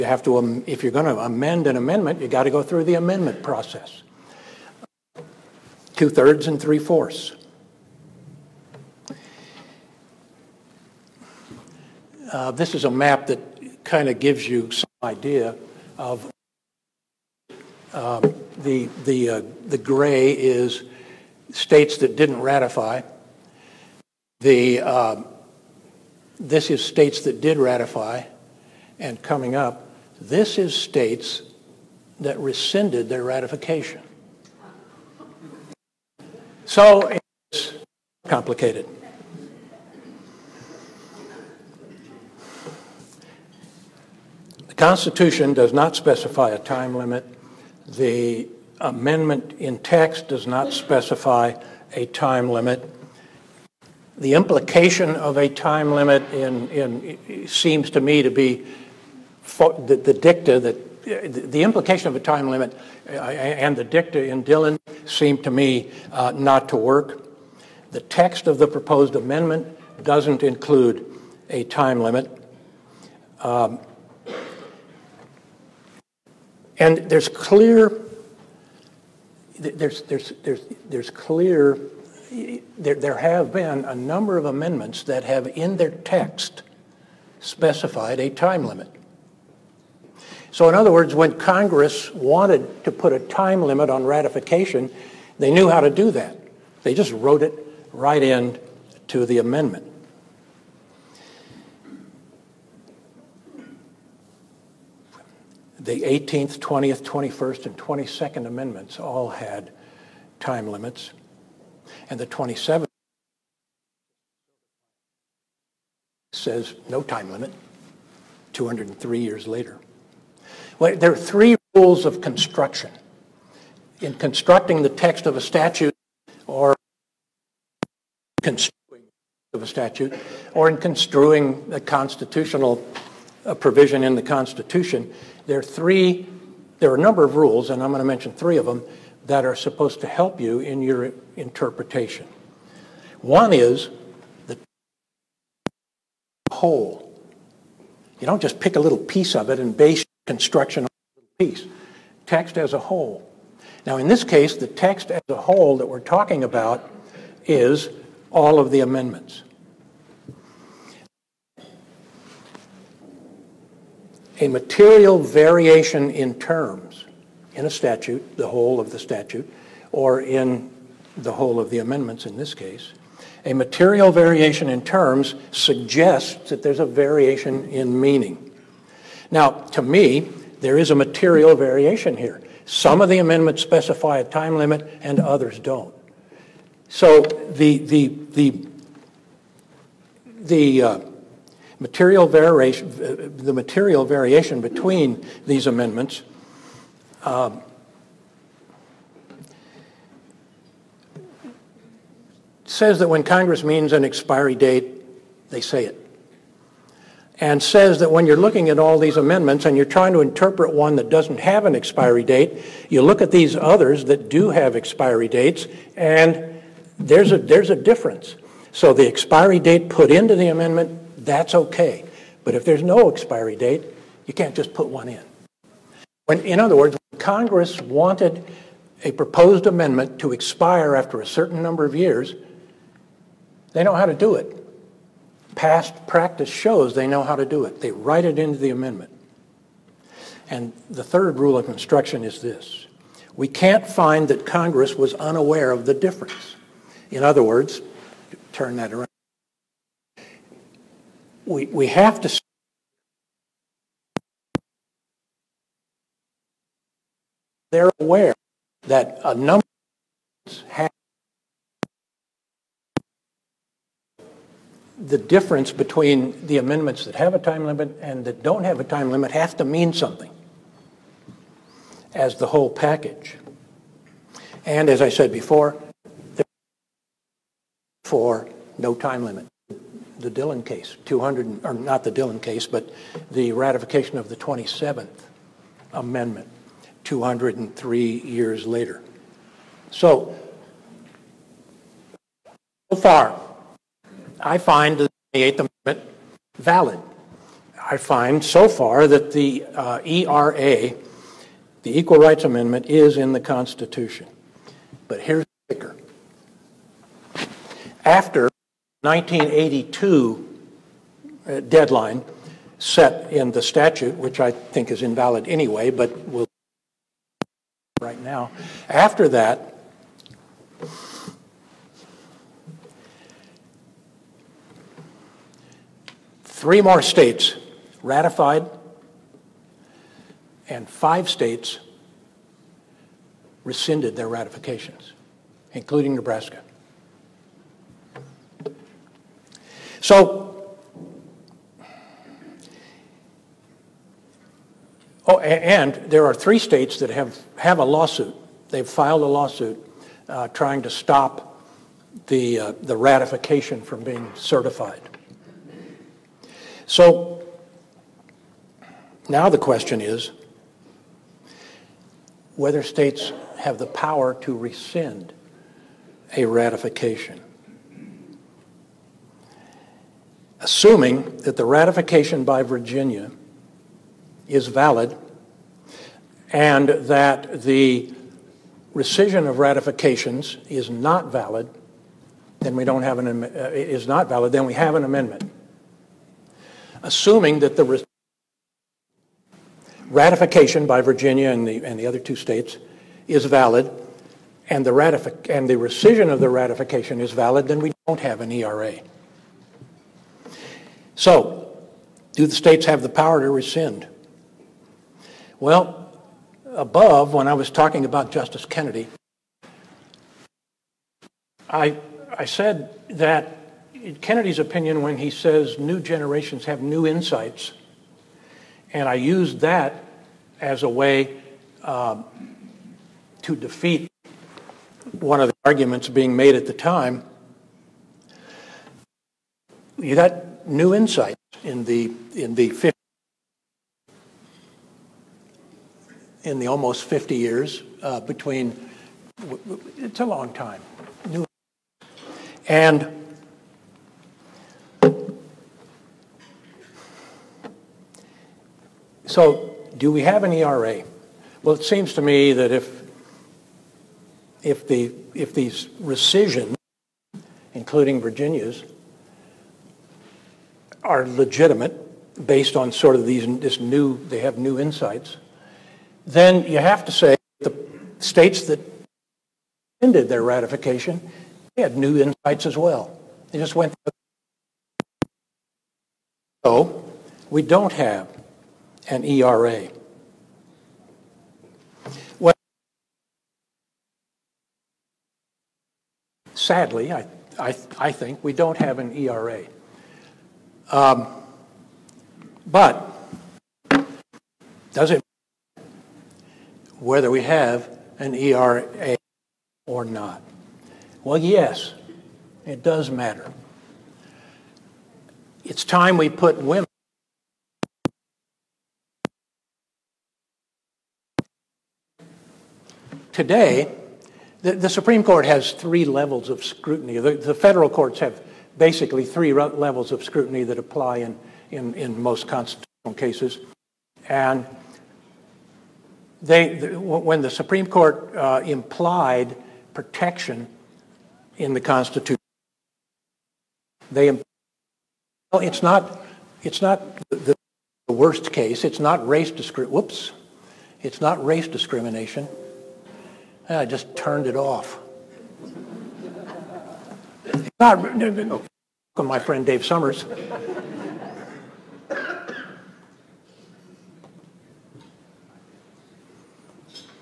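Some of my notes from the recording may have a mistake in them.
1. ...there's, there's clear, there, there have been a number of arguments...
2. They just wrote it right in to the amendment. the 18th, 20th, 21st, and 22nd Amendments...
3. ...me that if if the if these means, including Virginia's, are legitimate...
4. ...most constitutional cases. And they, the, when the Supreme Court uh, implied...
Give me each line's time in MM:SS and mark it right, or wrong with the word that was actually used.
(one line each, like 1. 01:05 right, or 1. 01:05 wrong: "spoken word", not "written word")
1. 01:20 wrong: "amendments", not "arguments"
2. 01:36 right
3. 07:32 wrong: "rescissions", not "means"
4. 08:42 right.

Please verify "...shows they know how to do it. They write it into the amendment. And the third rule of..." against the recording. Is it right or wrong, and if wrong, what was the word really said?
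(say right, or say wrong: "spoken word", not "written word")
right.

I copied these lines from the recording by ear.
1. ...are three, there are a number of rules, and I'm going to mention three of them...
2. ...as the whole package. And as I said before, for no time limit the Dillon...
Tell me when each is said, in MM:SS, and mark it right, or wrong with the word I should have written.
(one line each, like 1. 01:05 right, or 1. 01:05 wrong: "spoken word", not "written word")
1. 02:15 right
2. 04:32 right.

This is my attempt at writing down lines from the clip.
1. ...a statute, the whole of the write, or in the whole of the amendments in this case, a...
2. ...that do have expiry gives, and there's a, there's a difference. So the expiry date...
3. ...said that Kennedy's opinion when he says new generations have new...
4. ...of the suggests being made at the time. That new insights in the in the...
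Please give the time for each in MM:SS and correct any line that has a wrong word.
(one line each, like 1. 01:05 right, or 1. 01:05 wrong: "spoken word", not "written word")
1. 02:47 wrong: "statute", not "write"
2. 03:34 wrong: "dates", not "gives"
3. 06:52 right
4. 07:05 wrong: "arguments", not "suggests".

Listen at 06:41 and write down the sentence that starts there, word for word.
So, do the states have the power to rescind?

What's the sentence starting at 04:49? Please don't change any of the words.
So, so far, I find the 28th Amendment valid.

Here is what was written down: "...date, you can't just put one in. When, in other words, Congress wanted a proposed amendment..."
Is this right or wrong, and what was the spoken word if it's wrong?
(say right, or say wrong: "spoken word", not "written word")
right.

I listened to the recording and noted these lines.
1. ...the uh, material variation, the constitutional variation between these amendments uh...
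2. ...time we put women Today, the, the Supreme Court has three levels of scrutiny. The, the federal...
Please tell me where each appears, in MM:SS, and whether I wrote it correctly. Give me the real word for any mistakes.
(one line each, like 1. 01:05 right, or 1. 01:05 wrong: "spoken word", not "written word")
1. 03:10 wrong: "material", not "constitutional"
2. 08:25 right.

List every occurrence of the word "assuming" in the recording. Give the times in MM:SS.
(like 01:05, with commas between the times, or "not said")
06:10, 06:27.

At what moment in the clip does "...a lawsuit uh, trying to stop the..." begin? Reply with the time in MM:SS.
05:49.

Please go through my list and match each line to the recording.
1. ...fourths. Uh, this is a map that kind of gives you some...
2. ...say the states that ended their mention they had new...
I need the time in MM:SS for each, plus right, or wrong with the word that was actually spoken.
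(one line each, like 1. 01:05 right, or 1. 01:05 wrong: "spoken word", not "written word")
1. 00:06 right
2. 07:47 wrong: "ratification", not "mention".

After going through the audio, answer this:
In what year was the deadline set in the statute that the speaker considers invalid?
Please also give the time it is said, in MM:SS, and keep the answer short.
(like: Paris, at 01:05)
1982, at 05:09.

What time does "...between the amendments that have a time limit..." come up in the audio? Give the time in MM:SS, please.
04:25.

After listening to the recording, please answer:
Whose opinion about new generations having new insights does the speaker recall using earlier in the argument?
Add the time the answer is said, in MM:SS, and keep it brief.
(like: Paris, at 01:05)
Justice Kennedy, at 06:48.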